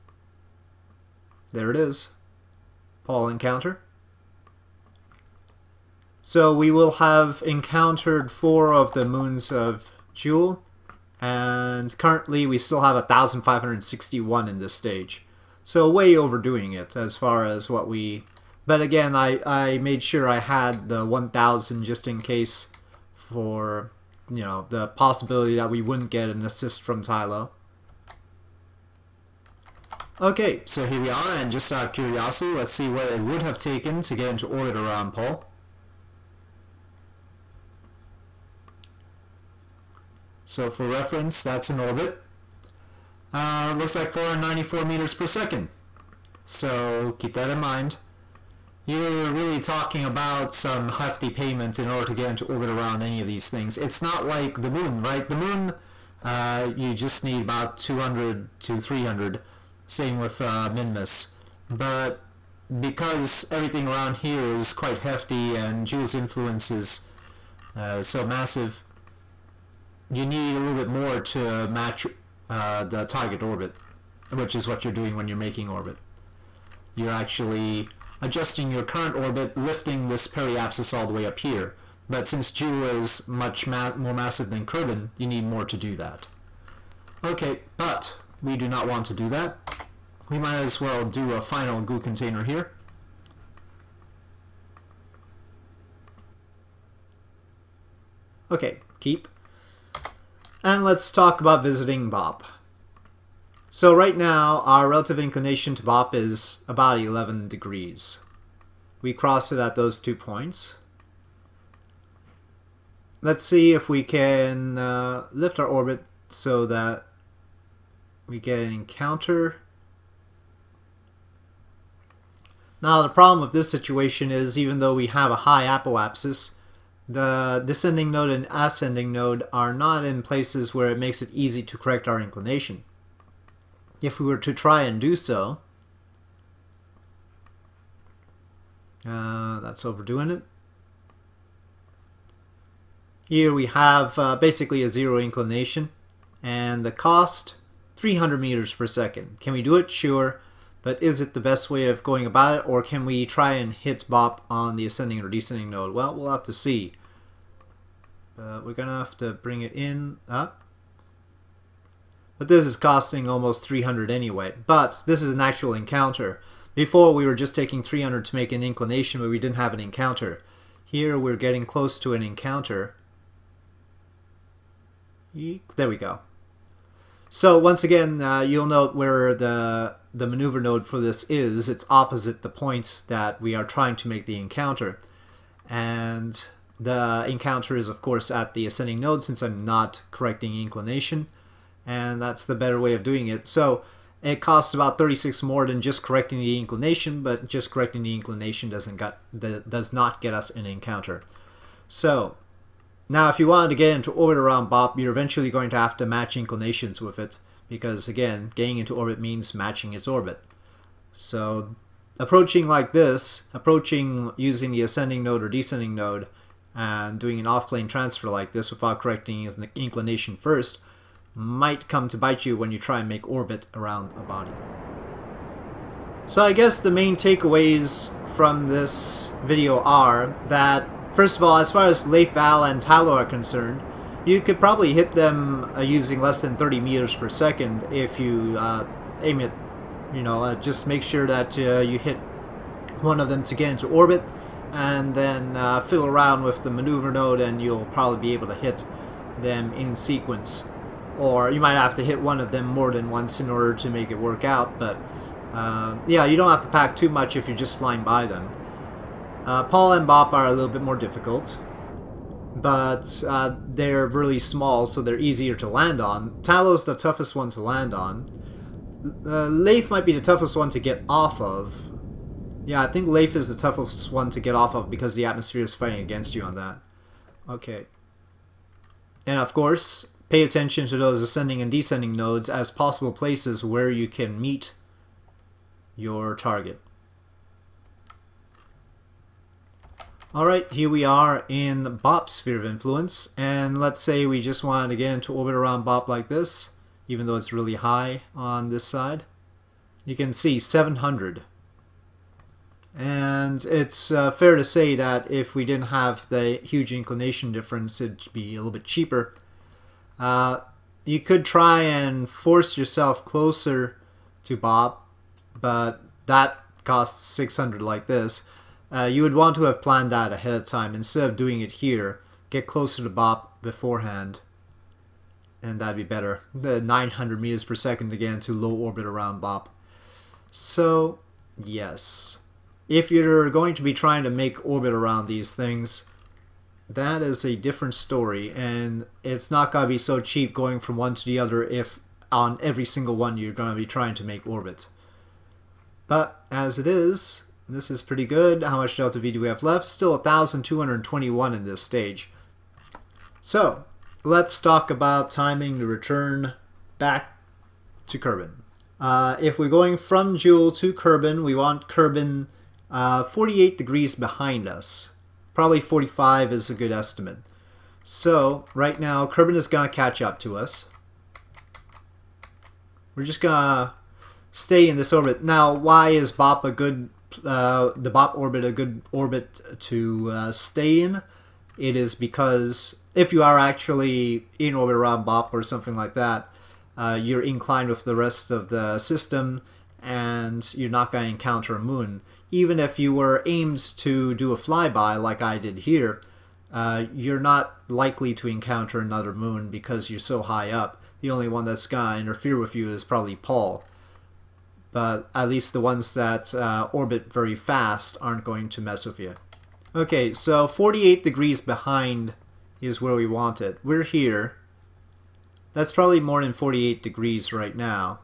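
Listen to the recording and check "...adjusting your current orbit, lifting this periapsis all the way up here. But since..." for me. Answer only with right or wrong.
right.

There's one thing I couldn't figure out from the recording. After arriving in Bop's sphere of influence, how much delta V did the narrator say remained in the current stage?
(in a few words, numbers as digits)
1,221.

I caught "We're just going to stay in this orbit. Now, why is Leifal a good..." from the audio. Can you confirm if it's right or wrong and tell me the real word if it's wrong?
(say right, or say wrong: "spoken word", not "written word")
wrong: "BOP", not "Leifal".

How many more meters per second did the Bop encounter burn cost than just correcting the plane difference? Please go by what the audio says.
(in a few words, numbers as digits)
36.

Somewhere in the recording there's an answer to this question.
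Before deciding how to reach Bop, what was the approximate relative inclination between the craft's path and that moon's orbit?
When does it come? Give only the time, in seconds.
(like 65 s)
106 s.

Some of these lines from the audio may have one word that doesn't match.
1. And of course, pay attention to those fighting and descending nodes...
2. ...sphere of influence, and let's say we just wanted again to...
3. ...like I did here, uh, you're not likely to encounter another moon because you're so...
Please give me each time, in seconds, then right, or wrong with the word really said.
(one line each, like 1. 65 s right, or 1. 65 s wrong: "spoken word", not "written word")
1. 279 s wrong: "ascending", not "fighting"
2. 292 s right
3. 395 s right.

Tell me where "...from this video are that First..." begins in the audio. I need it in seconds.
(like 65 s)
228 s.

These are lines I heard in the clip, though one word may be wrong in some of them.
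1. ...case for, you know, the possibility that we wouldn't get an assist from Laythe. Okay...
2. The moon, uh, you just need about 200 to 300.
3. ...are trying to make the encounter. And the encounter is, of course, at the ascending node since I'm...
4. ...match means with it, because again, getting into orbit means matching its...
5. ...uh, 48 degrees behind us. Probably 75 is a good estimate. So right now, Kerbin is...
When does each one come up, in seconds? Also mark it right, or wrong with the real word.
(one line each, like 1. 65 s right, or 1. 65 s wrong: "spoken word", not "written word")
1. 22 s wrong: "Tylo", not "Laythe"
2. 55 s right
3. 183 s right
4. 206 s wrong: "inclinations", not "means"
5. 362 s wrong: "45", not "75".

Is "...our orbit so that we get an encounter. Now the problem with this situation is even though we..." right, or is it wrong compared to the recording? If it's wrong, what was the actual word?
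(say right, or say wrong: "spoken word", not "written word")
right.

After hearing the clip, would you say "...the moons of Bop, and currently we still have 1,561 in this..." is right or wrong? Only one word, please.
wrong.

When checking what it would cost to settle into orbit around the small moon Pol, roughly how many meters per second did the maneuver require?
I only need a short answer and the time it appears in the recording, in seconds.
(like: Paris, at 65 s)
494 meters per second, at 44 s.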